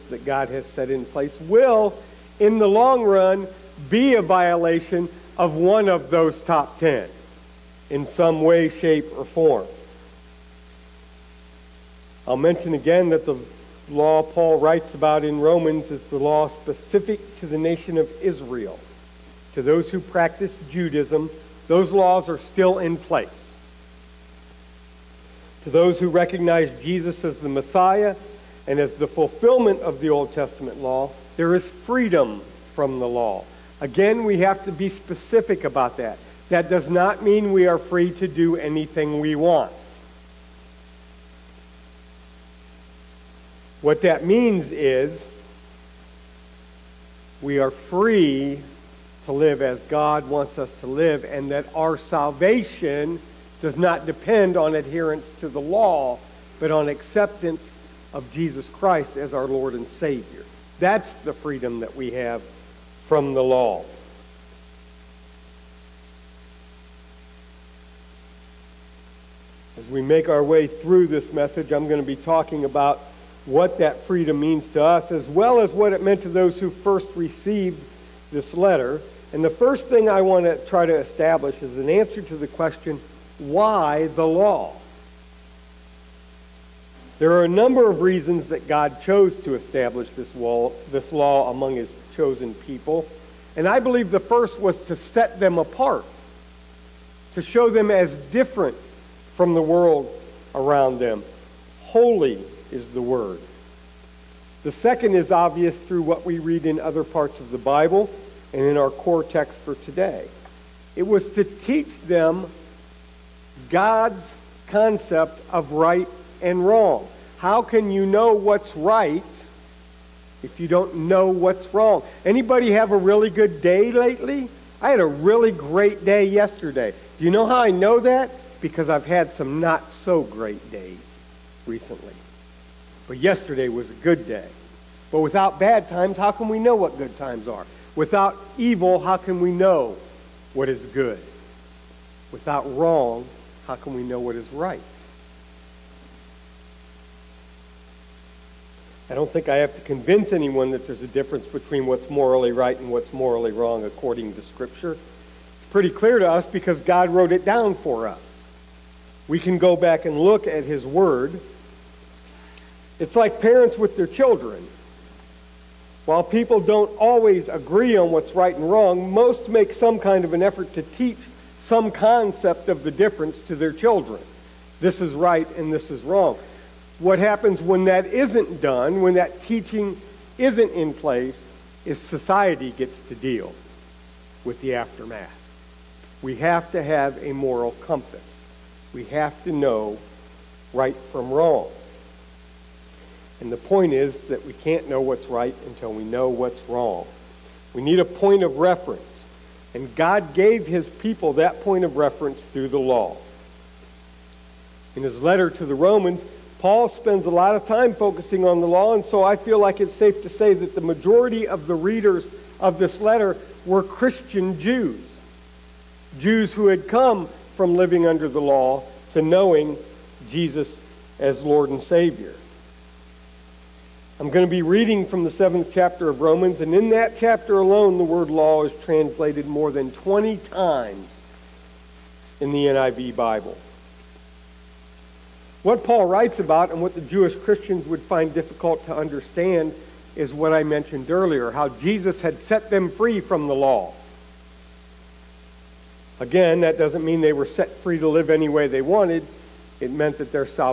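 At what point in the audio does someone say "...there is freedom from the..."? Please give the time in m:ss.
0:31.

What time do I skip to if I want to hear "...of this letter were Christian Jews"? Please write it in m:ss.
3:32.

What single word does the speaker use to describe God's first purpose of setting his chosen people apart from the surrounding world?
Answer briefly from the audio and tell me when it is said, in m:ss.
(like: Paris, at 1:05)
Holy, at 1:41.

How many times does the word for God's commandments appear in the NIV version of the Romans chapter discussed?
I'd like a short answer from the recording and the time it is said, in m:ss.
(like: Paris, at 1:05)
more than 20, at 3:49.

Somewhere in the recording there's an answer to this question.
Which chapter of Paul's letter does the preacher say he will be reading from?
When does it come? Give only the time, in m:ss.
3:45.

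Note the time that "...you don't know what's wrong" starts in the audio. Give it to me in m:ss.
2:00.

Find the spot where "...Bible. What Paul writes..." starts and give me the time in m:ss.
3:53.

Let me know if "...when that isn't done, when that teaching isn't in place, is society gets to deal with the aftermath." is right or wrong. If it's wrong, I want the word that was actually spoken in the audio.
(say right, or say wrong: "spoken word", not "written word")
right.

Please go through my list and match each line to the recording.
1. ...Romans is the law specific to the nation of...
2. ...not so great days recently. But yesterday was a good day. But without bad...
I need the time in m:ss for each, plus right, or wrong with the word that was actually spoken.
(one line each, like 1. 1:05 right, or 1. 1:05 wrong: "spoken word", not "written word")
1. 0:15 right
2. 2:09 right.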